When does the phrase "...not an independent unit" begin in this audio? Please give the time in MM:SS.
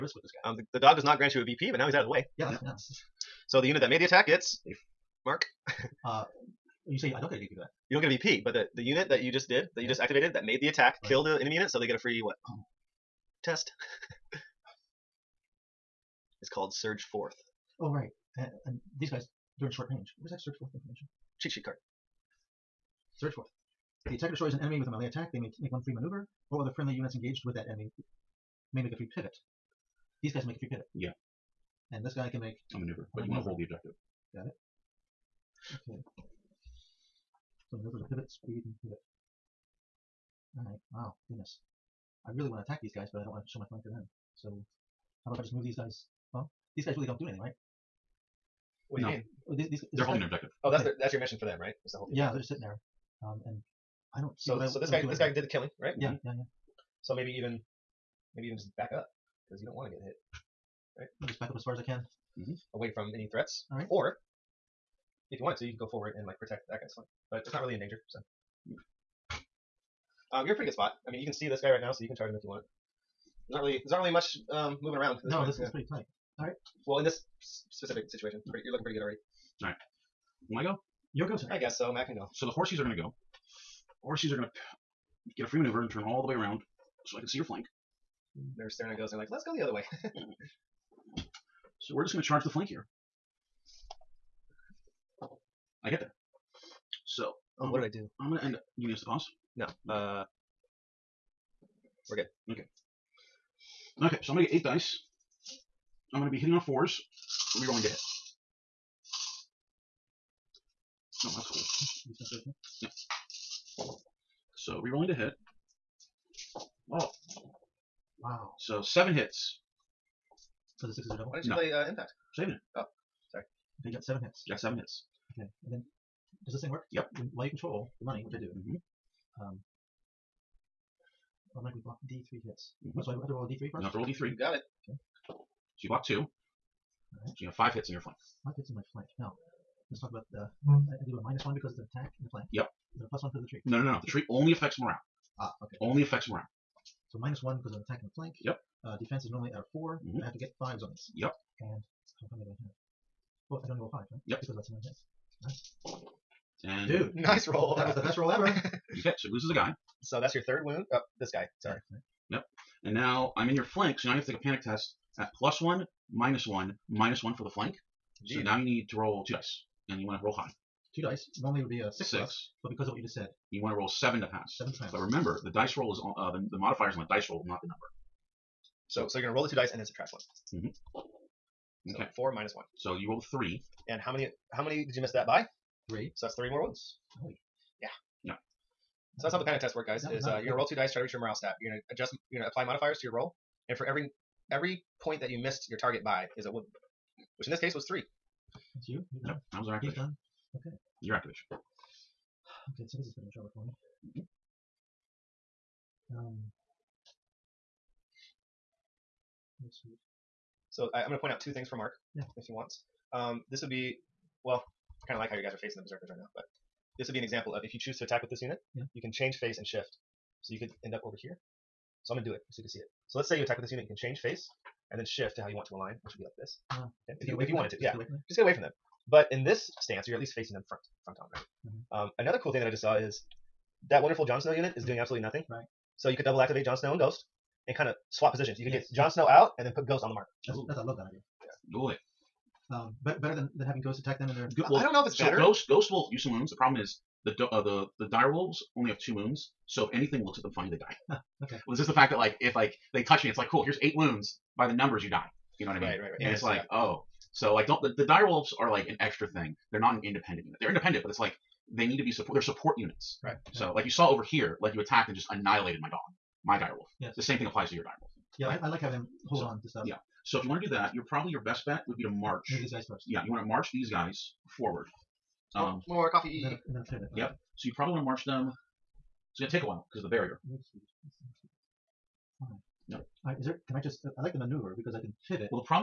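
04:19.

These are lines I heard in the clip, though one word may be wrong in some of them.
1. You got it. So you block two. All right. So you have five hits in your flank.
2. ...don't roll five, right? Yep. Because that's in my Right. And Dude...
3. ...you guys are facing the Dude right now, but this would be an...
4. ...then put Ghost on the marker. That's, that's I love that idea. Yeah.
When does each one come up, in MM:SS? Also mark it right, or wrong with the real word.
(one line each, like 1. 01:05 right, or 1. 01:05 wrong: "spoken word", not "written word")
1. 02:14 right
2. 02:33 right
3. 03:35 wrong: "Berserkers", not "Dude"
4. 03:59 right.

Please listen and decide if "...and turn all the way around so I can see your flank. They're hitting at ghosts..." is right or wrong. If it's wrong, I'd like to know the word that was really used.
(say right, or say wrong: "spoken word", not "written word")
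wrong: "staring", not "hitting".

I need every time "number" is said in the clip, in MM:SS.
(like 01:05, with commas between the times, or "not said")
02:57, 04:14.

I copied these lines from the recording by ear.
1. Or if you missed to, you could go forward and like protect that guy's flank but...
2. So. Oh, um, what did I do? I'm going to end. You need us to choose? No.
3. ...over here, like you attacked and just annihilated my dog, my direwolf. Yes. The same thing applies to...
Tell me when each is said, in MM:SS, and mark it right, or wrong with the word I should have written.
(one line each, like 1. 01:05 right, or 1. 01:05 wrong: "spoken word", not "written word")
1. 01:03 wrong: "wanted", not "missed"
2. 01:37 wrong: "pause", not "choose"
3. 04:24 right.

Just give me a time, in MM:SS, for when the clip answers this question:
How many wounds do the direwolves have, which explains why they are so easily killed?
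04:08.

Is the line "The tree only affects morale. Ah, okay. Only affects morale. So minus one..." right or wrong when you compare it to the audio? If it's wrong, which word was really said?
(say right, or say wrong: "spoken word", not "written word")
right.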